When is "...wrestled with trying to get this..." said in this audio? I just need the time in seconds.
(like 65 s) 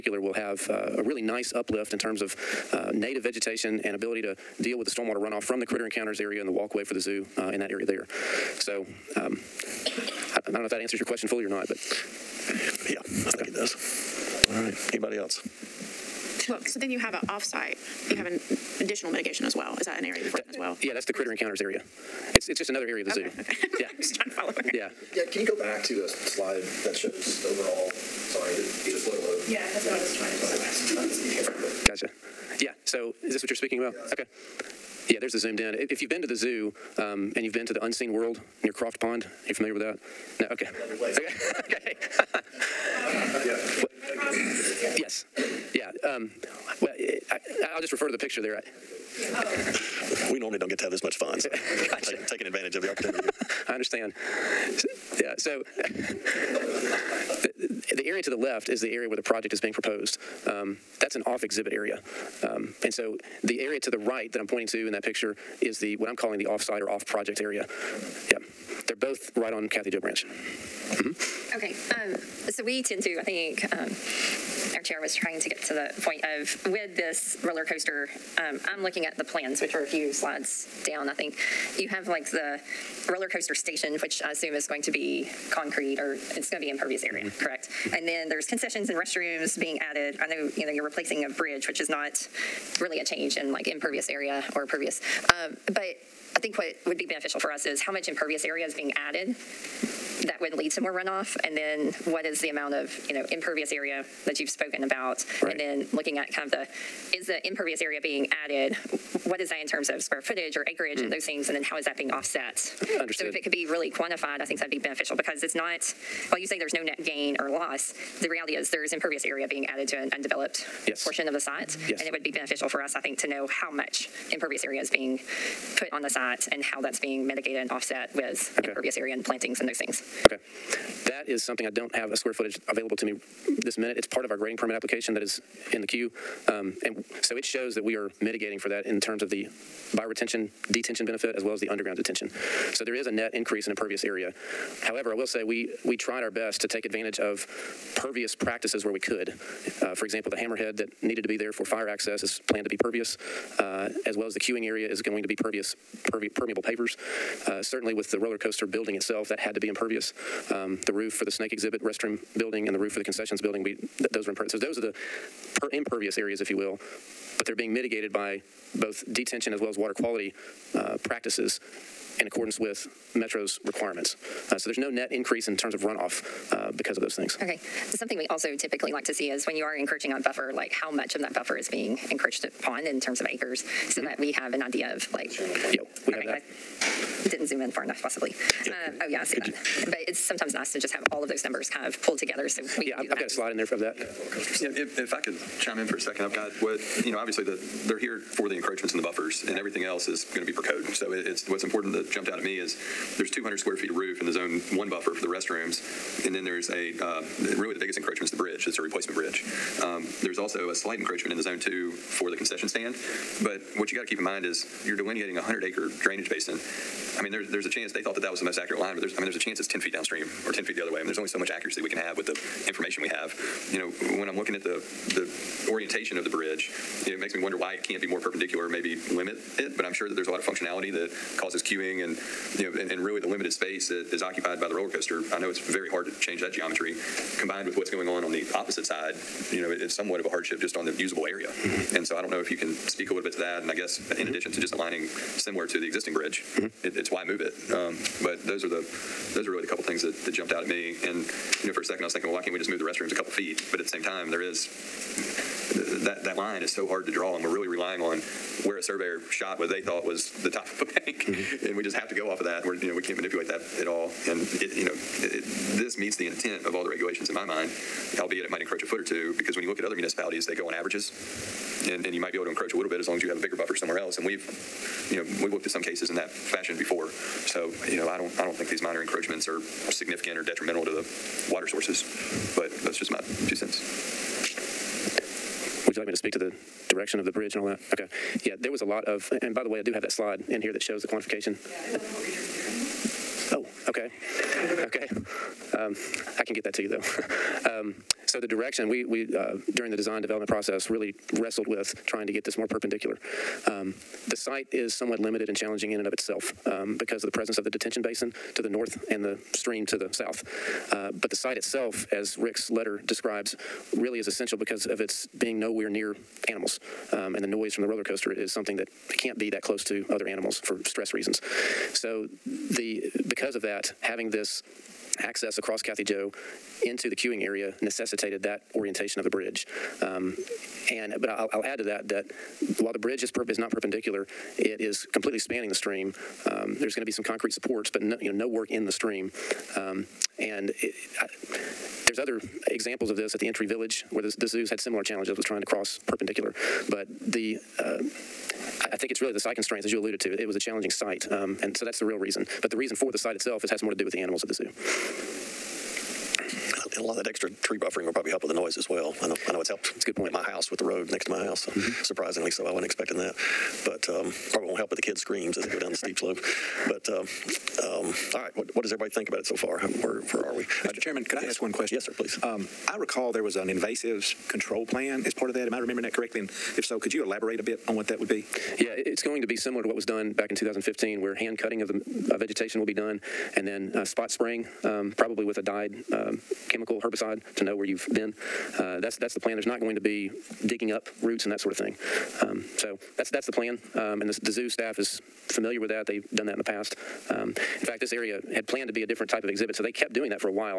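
301 s.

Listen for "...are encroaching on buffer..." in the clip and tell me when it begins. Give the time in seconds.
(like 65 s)
179 s.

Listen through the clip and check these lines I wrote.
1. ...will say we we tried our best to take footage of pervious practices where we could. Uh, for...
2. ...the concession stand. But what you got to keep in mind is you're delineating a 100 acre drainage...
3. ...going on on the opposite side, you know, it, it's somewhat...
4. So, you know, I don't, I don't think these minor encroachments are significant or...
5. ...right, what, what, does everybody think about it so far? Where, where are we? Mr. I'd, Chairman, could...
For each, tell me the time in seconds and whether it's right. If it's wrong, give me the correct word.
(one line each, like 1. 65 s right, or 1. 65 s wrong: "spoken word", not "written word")
1. 145 s wrong: "advantage", not "footage"
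2. 212 s right
3. 237 s right
4. 277 s right
5. 368 s right.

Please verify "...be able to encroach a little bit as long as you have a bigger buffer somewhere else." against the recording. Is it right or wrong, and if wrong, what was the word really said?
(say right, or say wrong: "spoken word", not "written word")
right.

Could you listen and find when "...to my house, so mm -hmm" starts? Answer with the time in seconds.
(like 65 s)
361 s.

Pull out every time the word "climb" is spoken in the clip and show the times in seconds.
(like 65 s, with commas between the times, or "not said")
not said.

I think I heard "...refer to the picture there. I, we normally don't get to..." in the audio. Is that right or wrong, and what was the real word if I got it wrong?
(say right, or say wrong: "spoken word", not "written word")
right.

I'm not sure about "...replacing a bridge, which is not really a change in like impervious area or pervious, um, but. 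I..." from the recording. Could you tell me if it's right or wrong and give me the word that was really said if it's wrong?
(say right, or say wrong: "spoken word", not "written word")
right.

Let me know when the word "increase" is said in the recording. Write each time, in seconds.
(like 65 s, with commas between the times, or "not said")
143 s, 175 s.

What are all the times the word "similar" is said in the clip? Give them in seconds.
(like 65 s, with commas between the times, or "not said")
245 s, 344 s, 379 s.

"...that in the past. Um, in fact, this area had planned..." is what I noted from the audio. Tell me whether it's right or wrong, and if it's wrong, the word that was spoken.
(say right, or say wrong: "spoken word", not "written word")
right.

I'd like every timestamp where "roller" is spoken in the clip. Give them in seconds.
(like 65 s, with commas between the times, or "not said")
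77 s, 83 s, 158 s, 234 s, 317 s.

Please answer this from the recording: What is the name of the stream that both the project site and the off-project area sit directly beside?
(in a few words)
Kathy Joe Branch.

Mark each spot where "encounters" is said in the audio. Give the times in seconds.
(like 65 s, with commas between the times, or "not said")
5 s, 21 s.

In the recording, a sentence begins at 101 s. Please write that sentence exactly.
And then what is the amount of, you know, impervious area that you've spoken about?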